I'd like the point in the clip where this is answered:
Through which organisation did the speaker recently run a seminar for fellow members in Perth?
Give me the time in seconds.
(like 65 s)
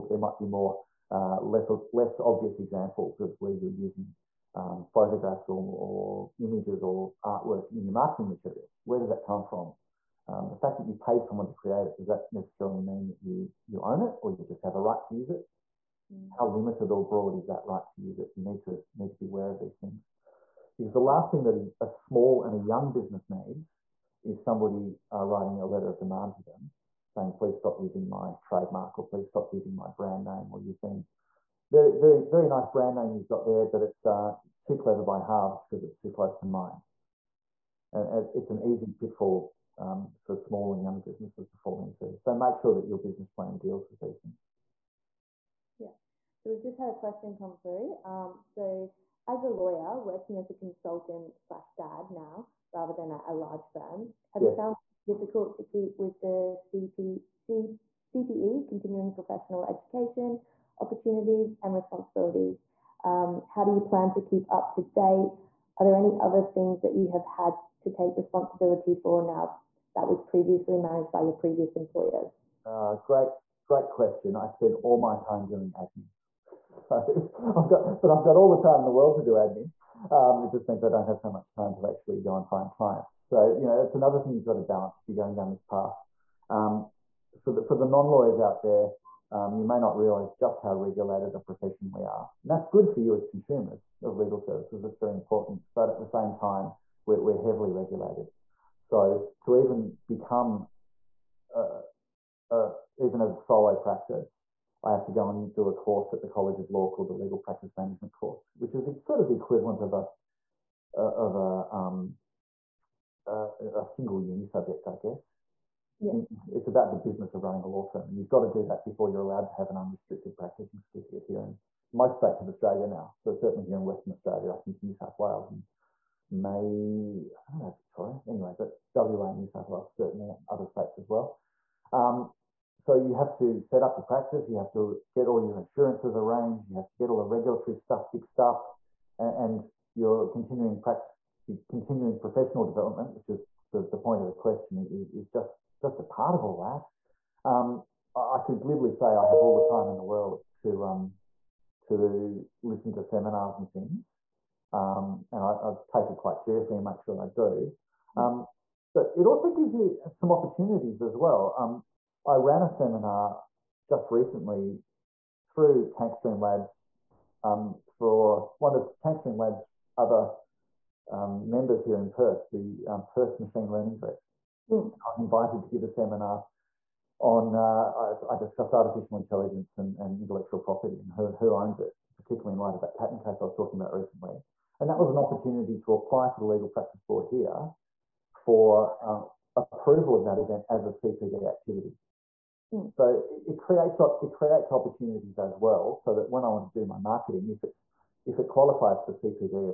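165 s.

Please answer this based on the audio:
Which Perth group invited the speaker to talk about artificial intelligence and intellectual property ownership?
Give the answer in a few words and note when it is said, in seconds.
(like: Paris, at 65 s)
Perth Machine Learning Group, at 173 s.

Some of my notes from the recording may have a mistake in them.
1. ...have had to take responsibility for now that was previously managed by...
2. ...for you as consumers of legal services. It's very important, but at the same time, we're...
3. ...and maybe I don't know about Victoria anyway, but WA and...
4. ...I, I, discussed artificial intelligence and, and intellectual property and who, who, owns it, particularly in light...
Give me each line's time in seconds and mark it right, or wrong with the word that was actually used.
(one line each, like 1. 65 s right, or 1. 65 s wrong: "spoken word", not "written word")
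1. 67 s right
2. 92 s right
3. 125 s right
4. 177 s right.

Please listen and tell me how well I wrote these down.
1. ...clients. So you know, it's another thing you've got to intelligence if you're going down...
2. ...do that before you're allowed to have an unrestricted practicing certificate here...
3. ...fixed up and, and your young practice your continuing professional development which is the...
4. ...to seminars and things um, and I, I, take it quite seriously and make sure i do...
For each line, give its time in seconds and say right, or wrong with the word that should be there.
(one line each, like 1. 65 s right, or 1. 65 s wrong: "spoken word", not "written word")
1. 82 s wrong: "balance", not "intelligence"
2. 118 s right
3. 138 s wrong: "continuing", not "young"
4. 152 s right.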